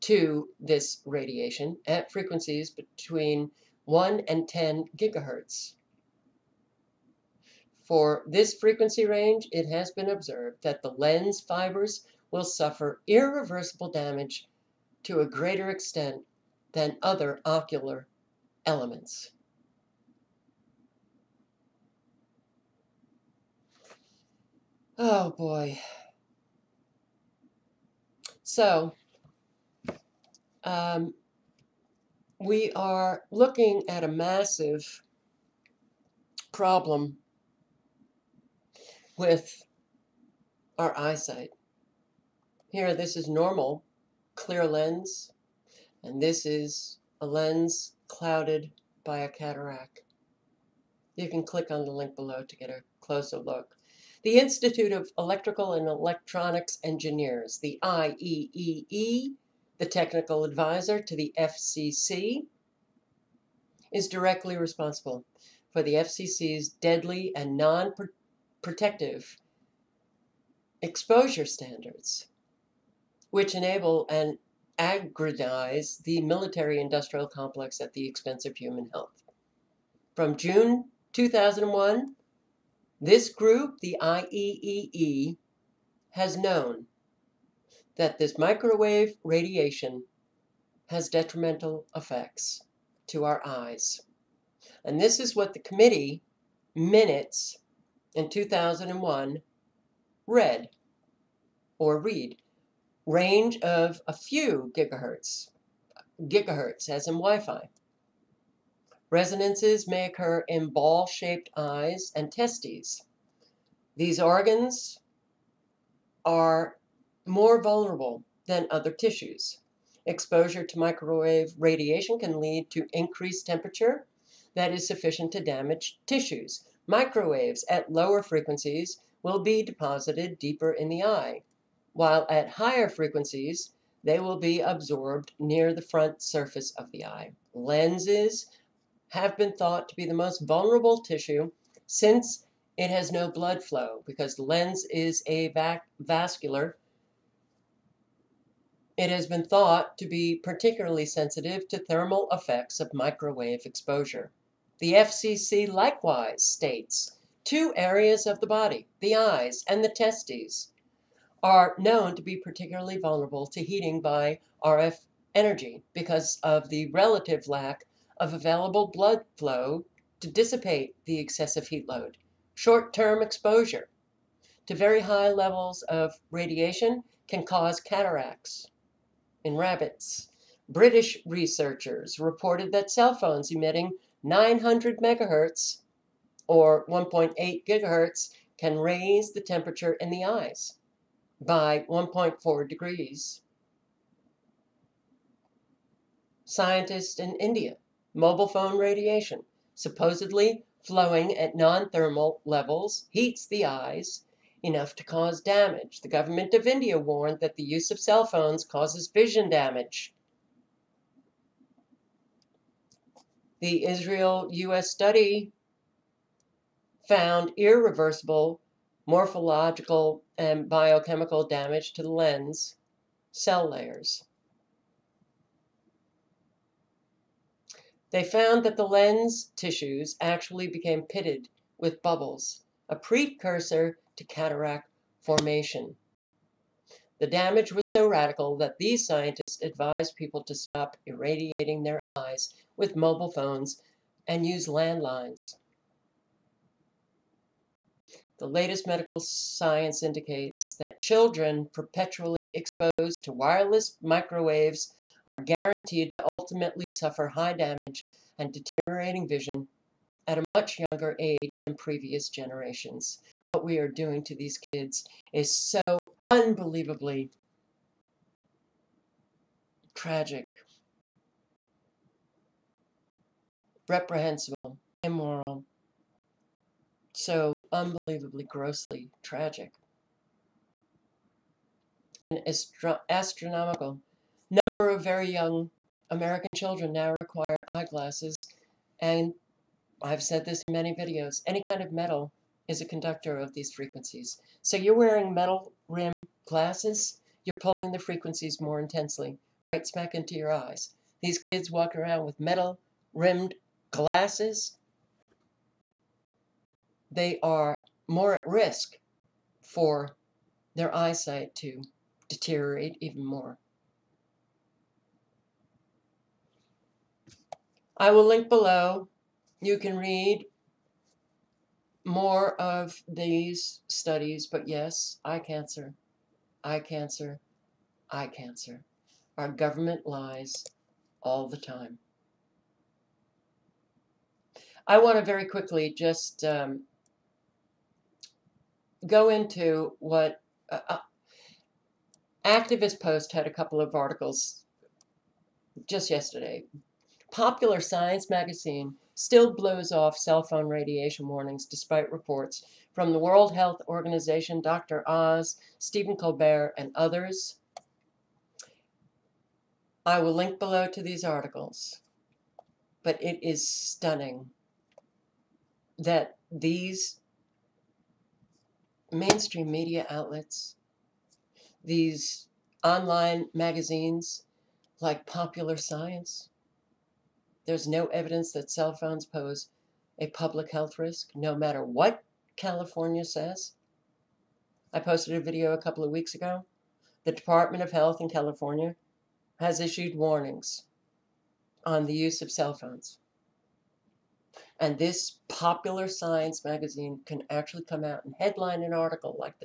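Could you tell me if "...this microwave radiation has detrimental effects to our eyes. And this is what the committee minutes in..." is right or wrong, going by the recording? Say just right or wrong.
right.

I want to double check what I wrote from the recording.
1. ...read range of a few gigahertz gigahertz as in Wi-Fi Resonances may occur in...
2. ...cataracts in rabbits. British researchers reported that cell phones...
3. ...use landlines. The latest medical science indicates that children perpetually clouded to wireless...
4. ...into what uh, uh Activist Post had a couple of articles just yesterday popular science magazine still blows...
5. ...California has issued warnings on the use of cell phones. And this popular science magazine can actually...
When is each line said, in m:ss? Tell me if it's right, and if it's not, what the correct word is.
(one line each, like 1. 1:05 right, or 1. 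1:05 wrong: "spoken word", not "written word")
1. 1:41 right
2. 2:57 right
3. 4:04 wrong: "exposed", not "clouded"
4. 5:39 right
5. 6:28 right.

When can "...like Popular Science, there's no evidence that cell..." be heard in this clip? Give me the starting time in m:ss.
6:15.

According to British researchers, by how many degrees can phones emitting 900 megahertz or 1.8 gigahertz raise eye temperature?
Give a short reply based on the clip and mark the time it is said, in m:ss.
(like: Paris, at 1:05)
1.4 degrees, at 3:11.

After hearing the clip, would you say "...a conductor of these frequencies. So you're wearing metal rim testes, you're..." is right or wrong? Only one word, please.
wrong.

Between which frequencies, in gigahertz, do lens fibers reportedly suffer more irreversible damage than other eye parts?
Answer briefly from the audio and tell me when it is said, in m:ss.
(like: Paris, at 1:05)
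1 and 10 gigahertz, at 0:03.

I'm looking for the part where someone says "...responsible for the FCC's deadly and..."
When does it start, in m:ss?
1:04.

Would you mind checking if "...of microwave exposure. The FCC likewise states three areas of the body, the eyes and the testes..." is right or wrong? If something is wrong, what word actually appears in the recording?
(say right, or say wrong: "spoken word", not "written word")
wrong: "two", not "three".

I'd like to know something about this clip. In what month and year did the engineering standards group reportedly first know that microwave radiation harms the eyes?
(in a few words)
June 2001.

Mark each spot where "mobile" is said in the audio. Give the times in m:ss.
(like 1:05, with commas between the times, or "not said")
3:18, 4:02.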